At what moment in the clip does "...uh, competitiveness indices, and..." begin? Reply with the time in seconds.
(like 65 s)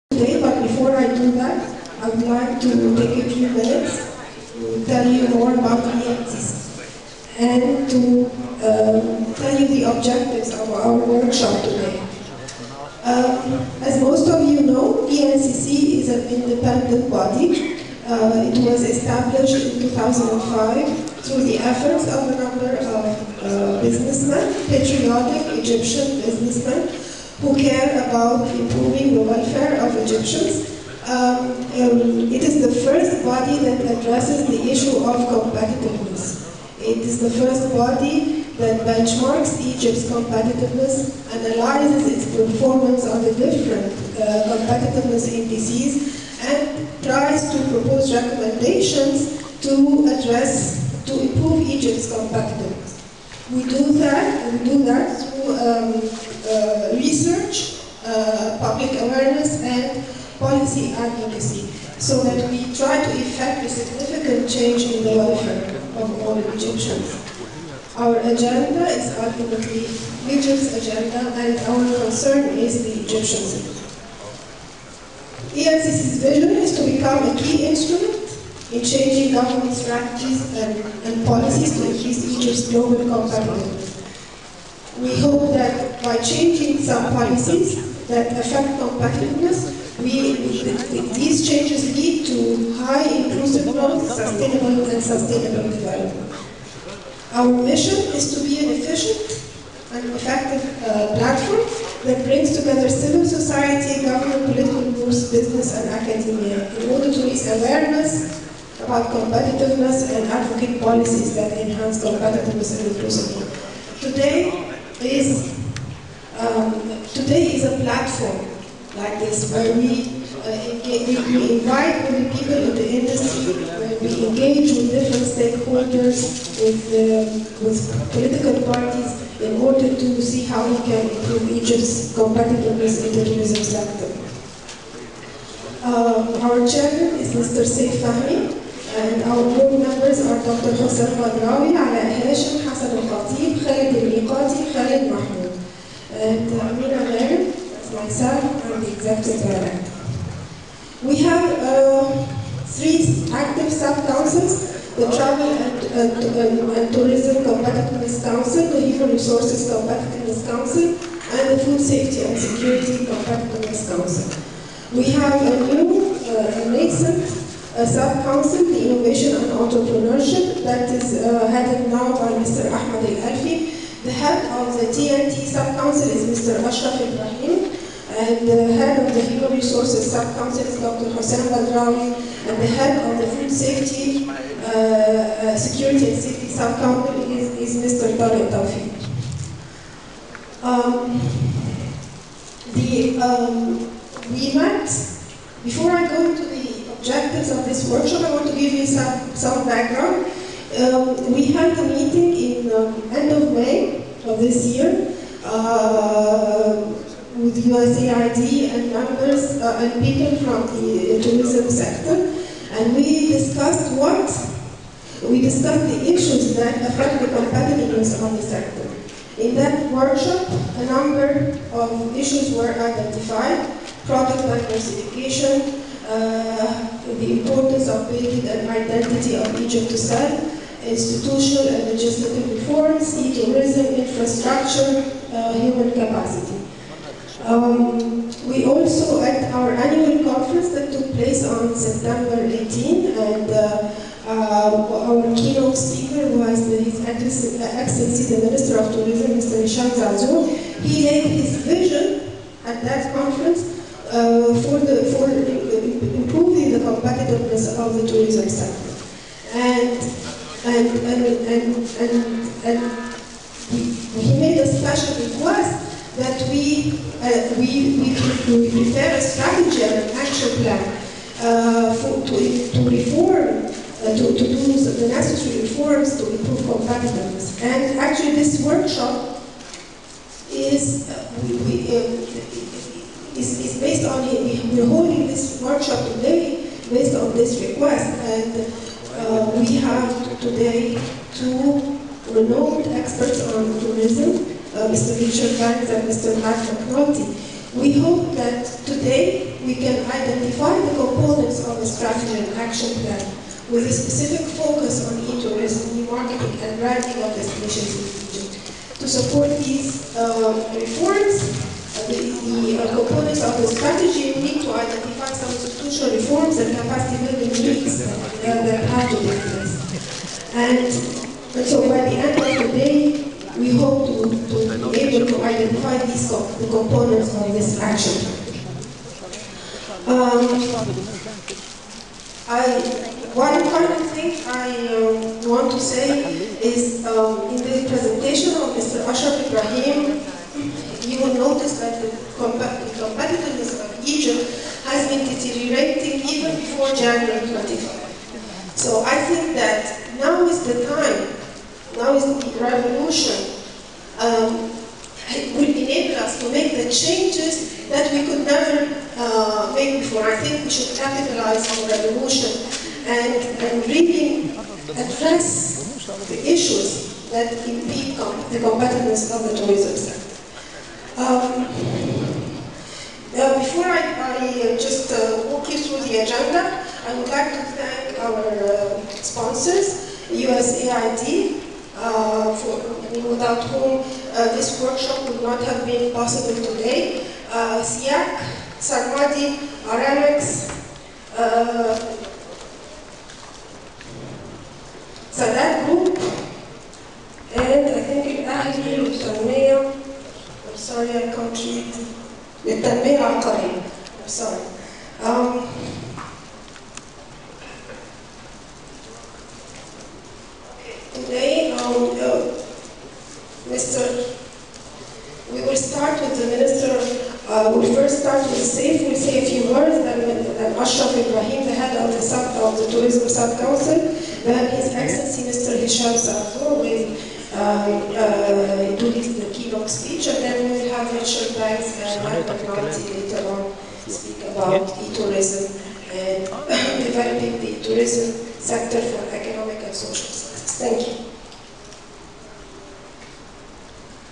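44 s.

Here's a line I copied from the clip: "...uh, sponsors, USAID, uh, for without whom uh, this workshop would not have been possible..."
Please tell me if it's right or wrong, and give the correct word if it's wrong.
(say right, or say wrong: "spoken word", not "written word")
right.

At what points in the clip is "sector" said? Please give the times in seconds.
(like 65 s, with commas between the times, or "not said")
133 s, 211 s, 218 s, 258 s, 369 s, 438 s.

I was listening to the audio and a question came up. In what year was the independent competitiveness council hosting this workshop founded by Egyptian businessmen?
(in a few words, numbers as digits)
2005.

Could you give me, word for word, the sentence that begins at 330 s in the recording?
Um, I, one important thing I uh, want to say is um, in the presentation of Mr.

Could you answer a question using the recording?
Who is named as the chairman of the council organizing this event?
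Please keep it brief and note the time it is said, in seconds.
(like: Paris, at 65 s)
Saif Fahmi, at 137 s.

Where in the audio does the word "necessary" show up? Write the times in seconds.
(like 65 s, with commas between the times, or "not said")
275 s.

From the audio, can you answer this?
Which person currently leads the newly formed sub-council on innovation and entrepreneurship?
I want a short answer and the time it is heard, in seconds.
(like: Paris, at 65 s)
Ahmed Al-Alfi, at 172 s.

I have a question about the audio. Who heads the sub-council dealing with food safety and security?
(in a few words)
Tarek Tawfiq.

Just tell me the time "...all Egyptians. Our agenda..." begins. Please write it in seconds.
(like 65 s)
66 s.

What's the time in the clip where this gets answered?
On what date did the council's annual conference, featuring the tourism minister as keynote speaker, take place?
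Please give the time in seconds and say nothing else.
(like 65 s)
241 s.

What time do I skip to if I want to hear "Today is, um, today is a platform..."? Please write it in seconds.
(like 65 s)
114 s.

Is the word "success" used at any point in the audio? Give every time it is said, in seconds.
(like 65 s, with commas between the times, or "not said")
440 s.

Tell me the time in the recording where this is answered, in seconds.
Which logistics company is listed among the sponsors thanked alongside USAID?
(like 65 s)
389 s.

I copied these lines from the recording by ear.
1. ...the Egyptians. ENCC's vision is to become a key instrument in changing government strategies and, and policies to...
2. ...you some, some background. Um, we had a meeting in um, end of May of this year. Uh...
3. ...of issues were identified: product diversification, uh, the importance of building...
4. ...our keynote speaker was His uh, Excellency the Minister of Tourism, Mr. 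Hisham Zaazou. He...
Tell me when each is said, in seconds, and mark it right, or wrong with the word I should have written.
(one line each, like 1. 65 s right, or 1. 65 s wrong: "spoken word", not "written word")
1. 72 s right
2. 198 s right
3. 221 s right
4. 245 s right.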